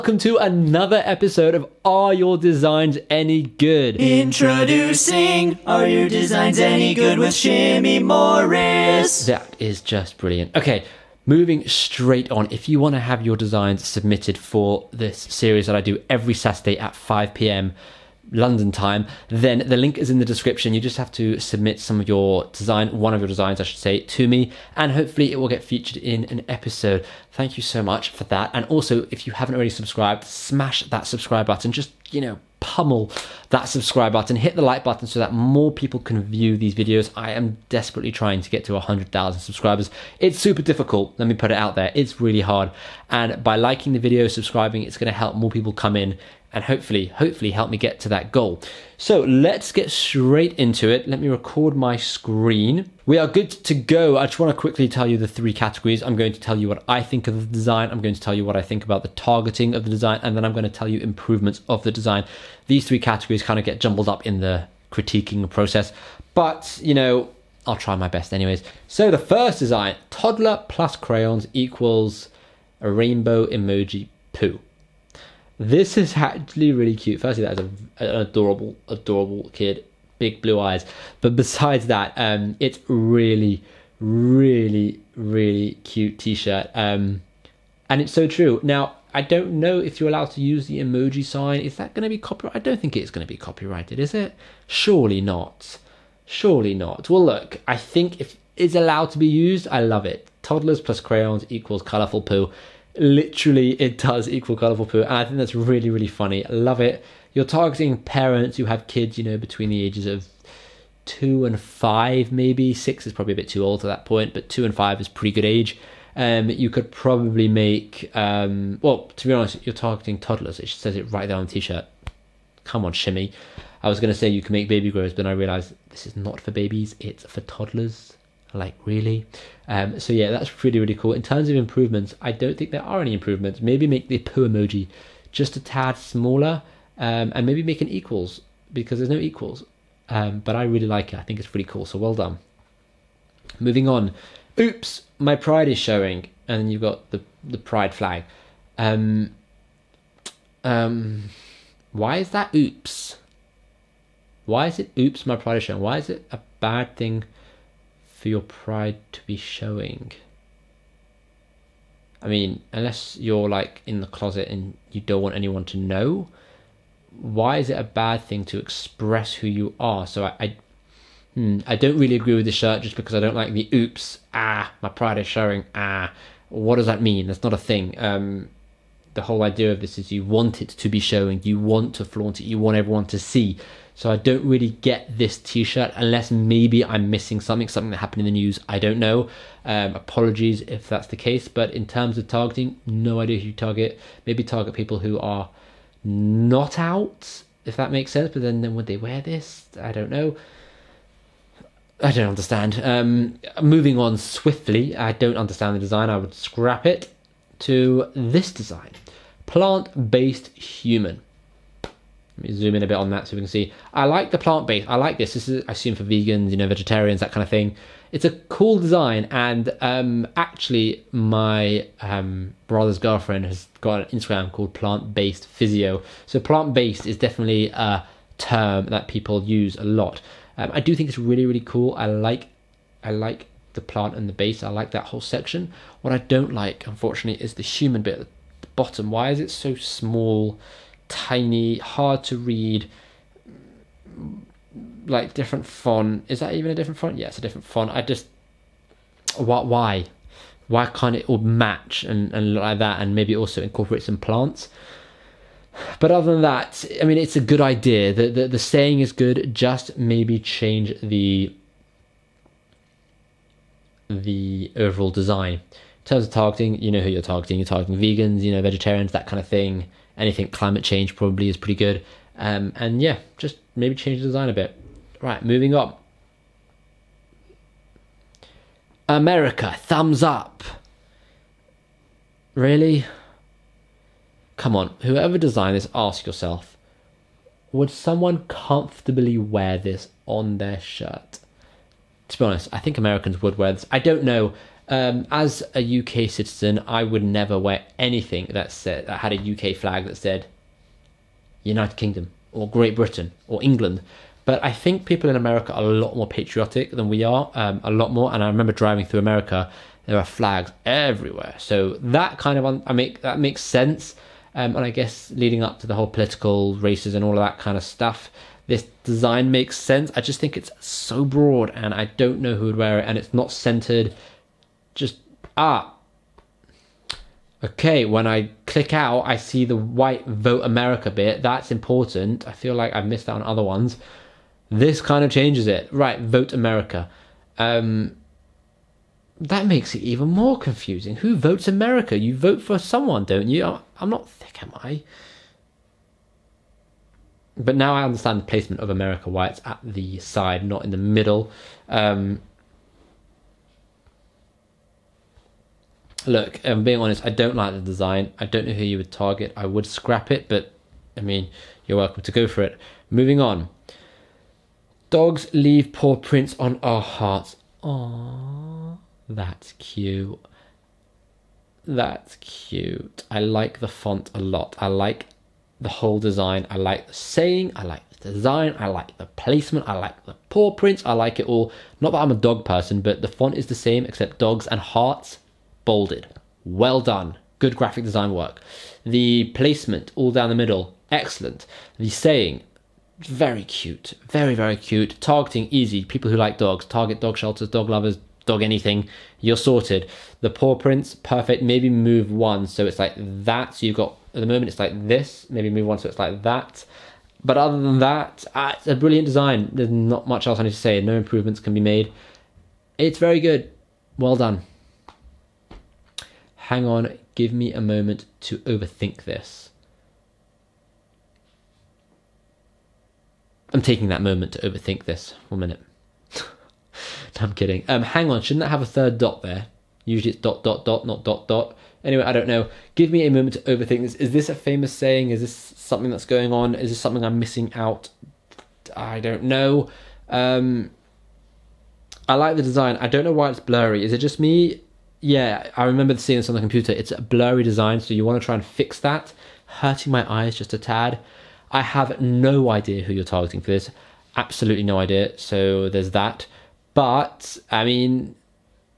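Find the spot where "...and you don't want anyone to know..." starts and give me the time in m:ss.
2:44.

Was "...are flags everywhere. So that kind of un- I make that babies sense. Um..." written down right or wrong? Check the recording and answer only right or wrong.
wrong.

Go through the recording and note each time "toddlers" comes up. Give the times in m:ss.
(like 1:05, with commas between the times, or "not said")
1:10, 1:40, 2:00, 2:07.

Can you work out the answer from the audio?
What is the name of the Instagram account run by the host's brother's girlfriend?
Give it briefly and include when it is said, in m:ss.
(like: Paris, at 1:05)
Plant Based Physio, at 3:44.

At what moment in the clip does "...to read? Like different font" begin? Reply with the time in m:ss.
4:02.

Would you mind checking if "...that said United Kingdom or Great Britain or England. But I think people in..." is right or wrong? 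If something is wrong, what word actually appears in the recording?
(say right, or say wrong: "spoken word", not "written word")
right.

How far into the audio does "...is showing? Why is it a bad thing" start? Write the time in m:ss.
2:35.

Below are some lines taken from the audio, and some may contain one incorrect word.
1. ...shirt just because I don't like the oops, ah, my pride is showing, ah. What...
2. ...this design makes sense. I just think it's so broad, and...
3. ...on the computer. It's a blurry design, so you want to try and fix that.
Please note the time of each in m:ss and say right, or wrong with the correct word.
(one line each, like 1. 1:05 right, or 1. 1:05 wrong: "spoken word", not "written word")
1. 2:52 right
2. 5:18 right
3. 7:26 right.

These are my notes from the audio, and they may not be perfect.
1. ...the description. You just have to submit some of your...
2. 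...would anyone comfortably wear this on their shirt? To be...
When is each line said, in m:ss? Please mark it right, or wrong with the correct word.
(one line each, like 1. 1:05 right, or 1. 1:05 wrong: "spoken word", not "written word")
1. 0:20 right
2. 4:47 wrong: "someone", not "anyone".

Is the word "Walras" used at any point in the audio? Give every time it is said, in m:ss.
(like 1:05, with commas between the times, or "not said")
not said.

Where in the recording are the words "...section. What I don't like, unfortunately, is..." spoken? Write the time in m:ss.
3:55.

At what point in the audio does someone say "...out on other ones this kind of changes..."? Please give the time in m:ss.
5:33.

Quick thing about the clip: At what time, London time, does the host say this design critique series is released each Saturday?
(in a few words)
5 p.m.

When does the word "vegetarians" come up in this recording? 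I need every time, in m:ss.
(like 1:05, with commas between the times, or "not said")
3:36, 4:28.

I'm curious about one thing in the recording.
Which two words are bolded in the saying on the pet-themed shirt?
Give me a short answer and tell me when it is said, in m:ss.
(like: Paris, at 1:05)
dogs and hearts, at 6:24.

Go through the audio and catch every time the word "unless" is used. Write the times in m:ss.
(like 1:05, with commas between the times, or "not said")
2:42, 3:05.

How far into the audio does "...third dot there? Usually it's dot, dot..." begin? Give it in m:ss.
7:08.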